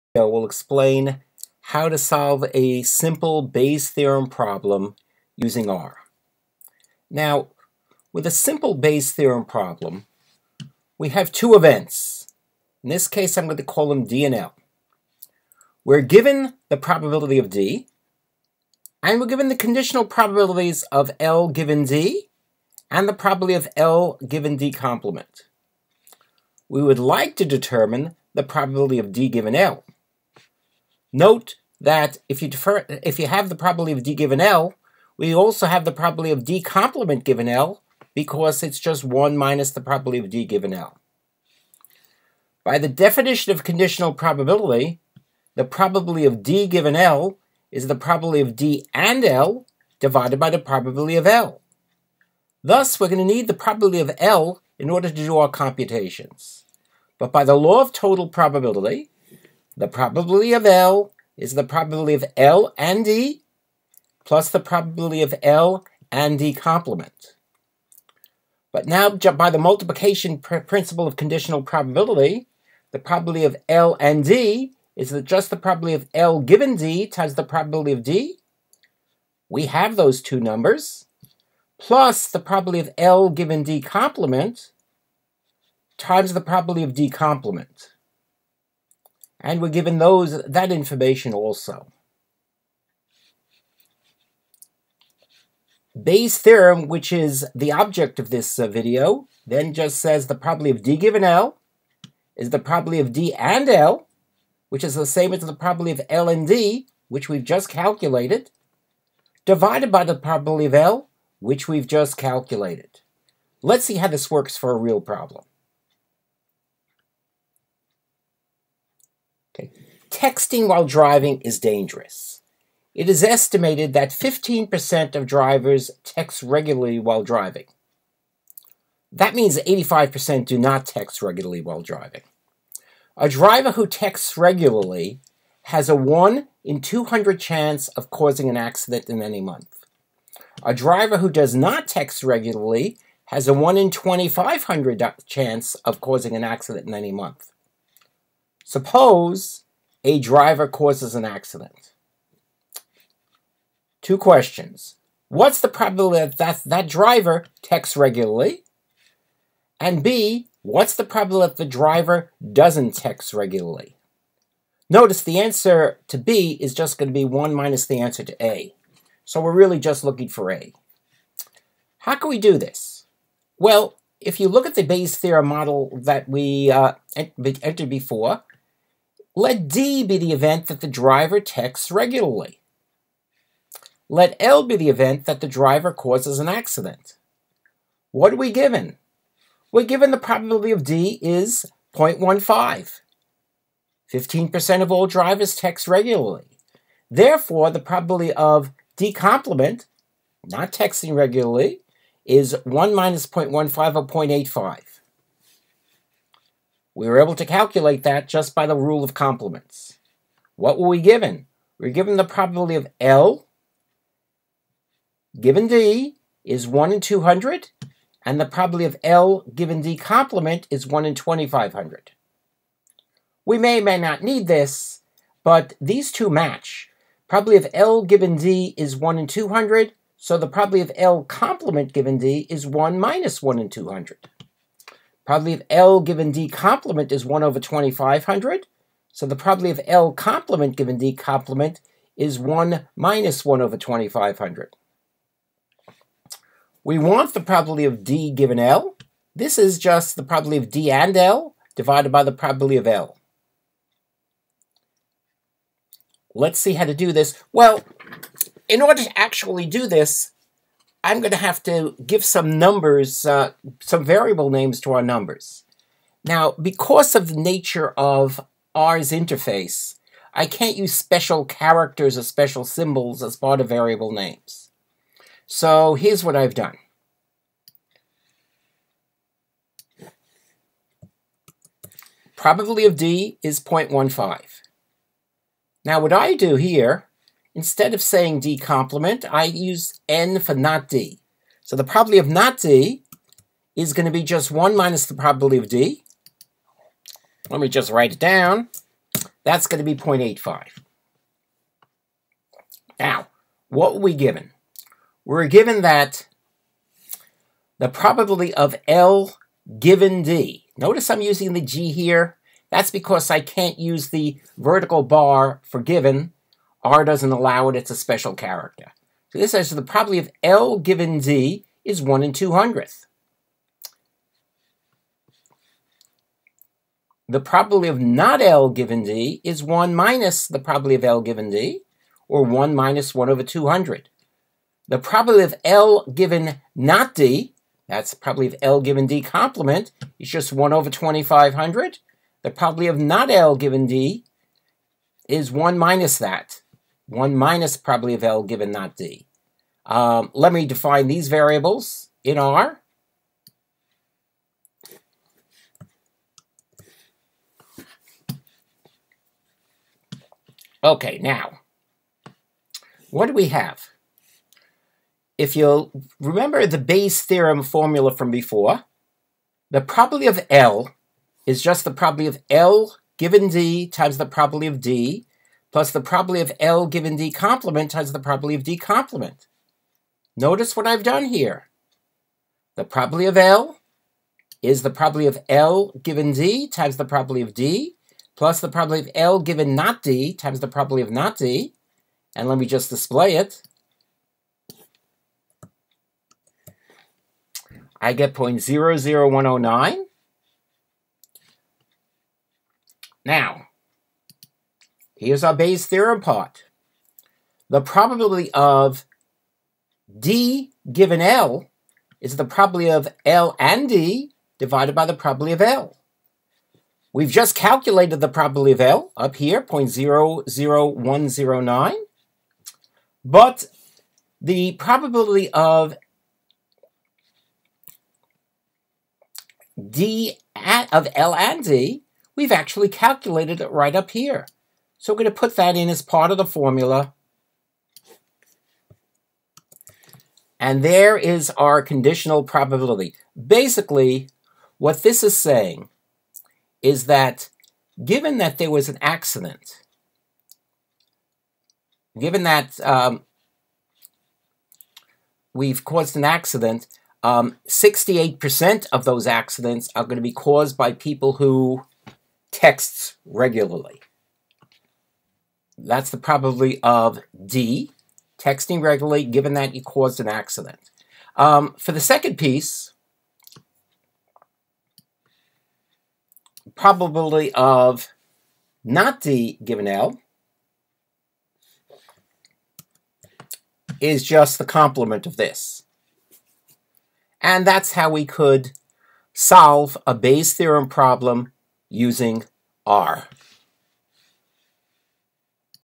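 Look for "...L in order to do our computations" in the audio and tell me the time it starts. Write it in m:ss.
0:54.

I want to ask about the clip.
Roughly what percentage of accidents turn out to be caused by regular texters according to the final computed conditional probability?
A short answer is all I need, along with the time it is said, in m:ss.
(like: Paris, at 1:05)
68%, at 7:37.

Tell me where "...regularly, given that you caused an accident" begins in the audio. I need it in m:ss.
7:48.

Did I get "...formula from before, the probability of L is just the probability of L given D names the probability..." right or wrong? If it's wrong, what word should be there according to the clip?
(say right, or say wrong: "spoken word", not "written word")
wrong: "times", not "names".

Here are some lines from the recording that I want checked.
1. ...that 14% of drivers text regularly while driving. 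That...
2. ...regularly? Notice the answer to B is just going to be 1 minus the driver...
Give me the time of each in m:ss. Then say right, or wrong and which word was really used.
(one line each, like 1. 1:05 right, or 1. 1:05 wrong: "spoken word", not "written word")
1. 2:03 wrong: "15", not "14"
2. 2:43 wrong: "answer", not "driver".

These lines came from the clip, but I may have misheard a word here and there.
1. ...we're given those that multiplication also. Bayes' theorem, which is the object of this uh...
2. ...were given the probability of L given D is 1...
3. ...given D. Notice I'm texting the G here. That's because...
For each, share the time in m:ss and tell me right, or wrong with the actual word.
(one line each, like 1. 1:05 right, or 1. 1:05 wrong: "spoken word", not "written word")
1. 1:29 wrong: "information", not "multiplication"
2. 3:31 right
3. 5:09 wrong: "using", not "texting".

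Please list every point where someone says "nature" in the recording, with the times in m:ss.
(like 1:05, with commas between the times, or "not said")
4:27.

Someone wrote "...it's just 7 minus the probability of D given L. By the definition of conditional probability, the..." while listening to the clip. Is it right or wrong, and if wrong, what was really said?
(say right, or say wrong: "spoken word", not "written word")
wrong: "1", not "7".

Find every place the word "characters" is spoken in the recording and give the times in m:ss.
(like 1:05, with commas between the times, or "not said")
4:31, 5:18.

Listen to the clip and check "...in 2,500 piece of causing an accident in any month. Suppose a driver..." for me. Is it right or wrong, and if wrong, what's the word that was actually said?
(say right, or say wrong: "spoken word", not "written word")
wrong: "chance", not "piece".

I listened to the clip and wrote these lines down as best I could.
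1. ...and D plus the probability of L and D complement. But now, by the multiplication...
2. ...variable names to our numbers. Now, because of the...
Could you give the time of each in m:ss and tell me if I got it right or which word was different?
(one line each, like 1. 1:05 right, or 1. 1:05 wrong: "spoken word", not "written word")
1. 1:02 right
2. 4:24 right.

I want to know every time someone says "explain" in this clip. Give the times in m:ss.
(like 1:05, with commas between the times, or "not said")
0:00.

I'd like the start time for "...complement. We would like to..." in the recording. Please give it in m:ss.
0:24.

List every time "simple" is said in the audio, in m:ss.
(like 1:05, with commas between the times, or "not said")
0:02, 0:08.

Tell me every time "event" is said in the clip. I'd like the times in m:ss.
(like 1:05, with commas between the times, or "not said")
0:11, 3:00, 3:04.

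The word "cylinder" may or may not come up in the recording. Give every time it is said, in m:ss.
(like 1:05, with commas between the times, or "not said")
not said.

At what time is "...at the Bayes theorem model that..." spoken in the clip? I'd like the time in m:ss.
2:54.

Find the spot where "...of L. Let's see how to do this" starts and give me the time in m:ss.
4:12.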